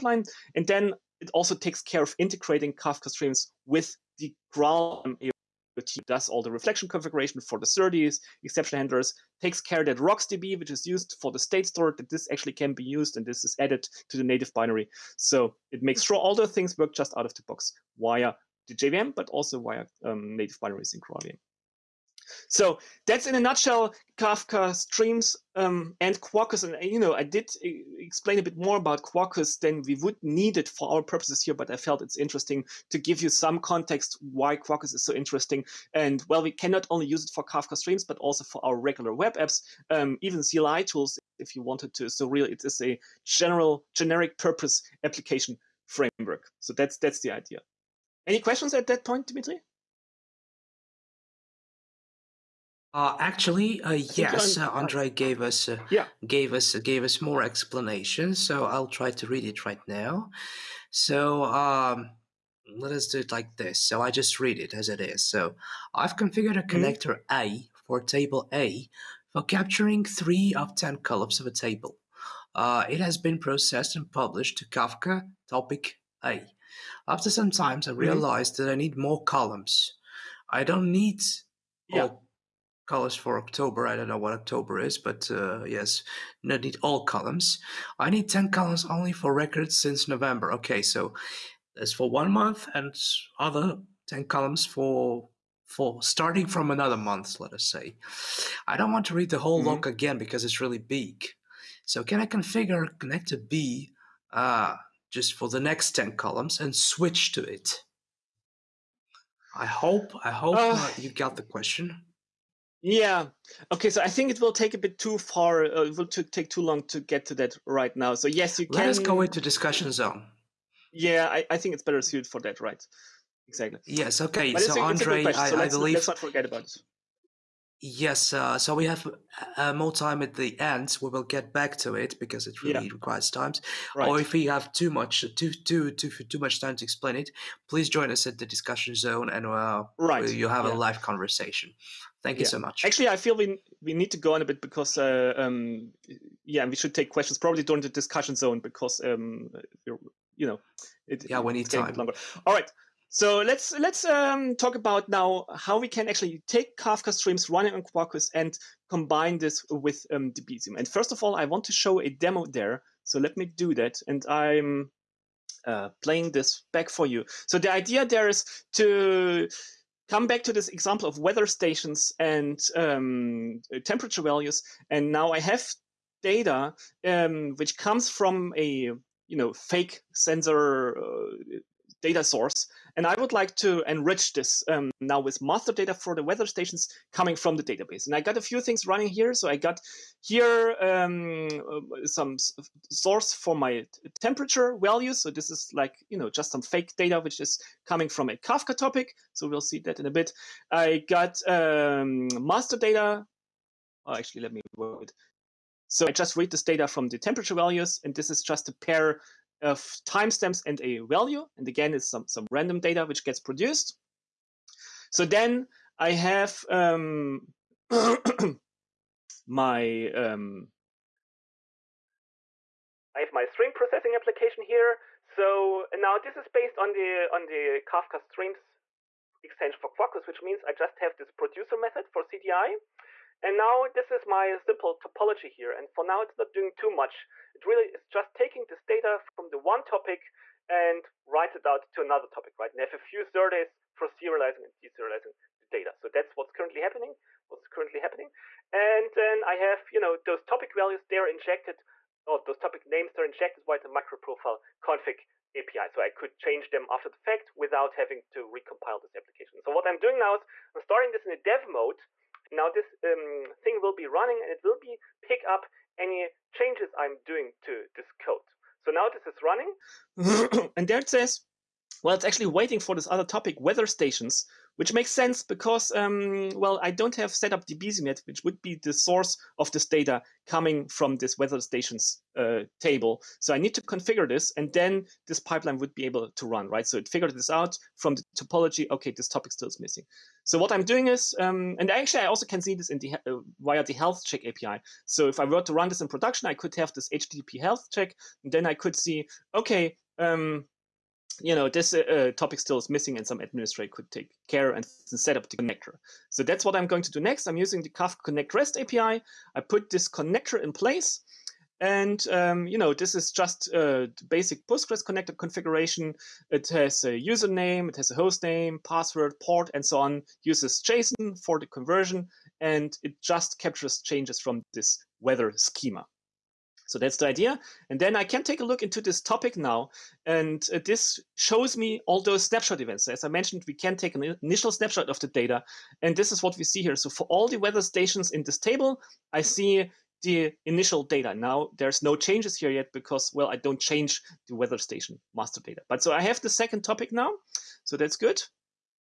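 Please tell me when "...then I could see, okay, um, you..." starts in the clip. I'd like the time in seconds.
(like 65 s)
298 s.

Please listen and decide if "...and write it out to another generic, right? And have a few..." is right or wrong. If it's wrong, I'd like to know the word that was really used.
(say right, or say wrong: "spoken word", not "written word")
wrong: "topic", not "generic".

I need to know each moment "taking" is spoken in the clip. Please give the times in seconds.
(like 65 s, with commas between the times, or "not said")
238 s.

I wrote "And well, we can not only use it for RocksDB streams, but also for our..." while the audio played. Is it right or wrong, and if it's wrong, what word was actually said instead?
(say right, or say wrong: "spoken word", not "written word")
wrong: "Kafka", not "RocksDB".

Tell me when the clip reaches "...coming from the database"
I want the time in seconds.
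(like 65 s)
187 s.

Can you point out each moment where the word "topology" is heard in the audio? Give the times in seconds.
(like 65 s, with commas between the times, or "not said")
234 s, 288 s.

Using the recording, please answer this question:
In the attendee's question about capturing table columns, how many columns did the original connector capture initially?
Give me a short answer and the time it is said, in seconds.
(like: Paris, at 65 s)
3, at 70 s.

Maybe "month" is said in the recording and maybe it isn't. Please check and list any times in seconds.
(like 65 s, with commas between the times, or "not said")
92 s, 96 s.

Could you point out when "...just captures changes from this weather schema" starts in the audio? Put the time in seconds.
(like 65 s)
323 s.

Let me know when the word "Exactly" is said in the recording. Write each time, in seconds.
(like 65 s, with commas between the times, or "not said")
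123 s.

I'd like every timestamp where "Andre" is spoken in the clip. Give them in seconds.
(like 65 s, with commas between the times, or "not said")
54 s, 124 s.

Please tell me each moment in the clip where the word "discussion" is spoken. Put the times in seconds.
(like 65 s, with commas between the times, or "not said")
119 s, 138 s, 147 s.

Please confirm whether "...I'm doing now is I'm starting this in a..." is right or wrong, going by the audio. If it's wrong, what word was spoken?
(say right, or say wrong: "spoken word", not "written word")
right.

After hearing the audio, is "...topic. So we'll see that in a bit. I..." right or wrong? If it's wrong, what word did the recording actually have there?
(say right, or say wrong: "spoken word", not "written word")
right.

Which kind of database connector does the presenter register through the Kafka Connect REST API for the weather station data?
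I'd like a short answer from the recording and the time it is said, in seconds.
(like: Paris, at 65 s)
Postgres, at 314 s.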